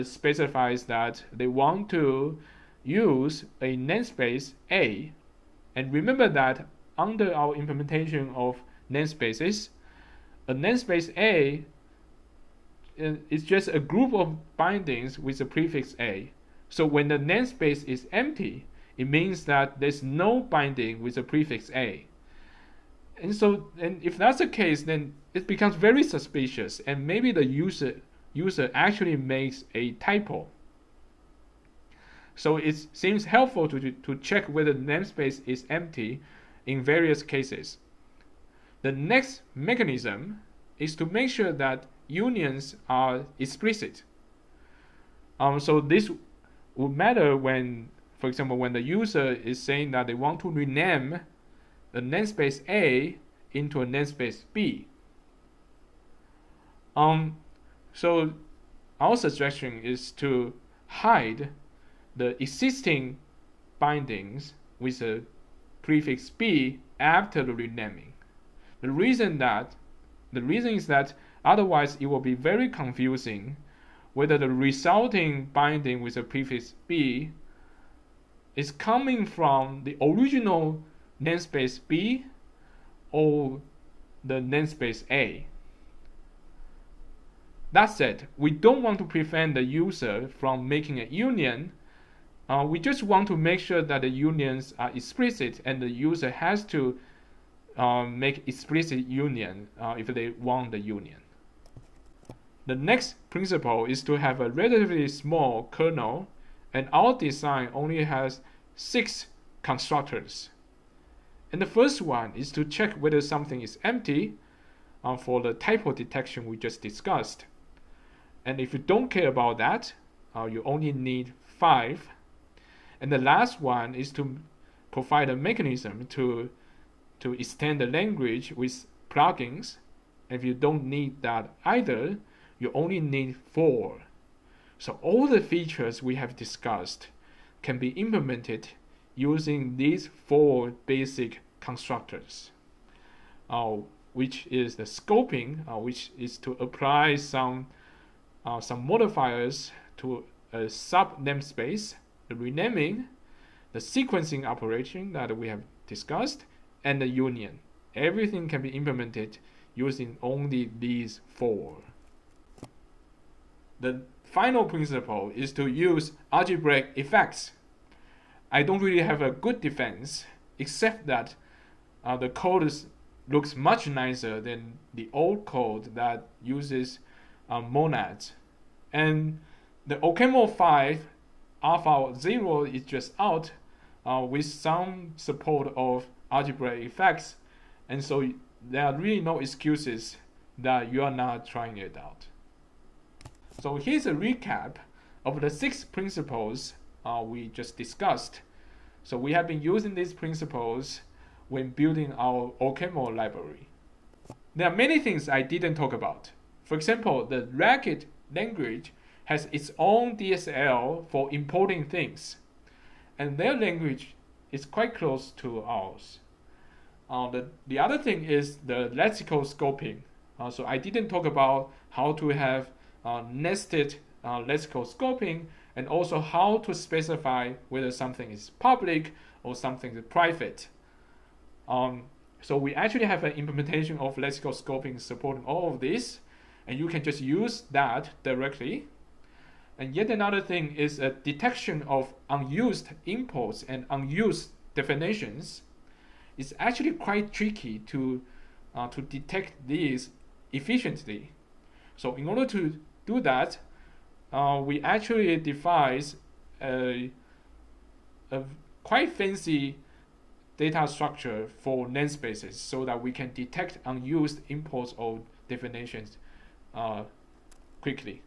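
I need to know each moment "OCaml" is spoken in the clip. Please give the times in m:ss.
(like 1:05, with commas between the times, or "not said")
2:59, 3:22.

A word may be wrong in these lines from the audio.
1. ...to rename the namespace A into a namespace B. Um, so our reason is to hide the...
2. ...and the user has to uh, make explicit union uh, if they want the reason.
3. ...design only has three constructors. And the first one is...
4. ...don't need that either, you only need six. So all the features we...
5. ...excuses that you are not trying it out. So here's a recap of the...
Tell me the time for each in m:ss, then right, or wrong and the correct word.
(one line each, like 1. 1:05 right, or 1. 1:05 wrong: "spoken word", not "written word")
1. 0:50 wrong: "suggestion", not "reason"
2. 1:35 wrong: "union", not "reason"
3. 1:47 wrong: "six", not "three"
4. 2:10 wrong: "four", not "six"
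5. 3:09 right.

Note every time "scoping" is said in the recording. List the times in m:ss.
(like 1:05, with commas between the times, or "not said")
2:24, 3:39, 3:44, 3:54.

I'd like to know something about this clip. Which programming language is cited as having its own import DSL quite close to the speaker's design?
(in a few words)
Racket.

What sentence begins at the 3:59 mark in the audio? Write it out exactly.
And yet another thing is a detection of unused imports and unused definitions.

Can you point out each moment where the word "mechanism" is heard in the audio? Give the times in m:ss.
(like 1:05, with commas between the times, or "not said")
0:39, 2:05.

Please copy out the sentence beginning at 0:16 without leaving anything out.
So when the namespace is empty, it means that there's no binding with the prefix A.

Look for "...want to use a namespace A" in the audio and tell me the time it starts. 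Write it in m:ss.
0:01.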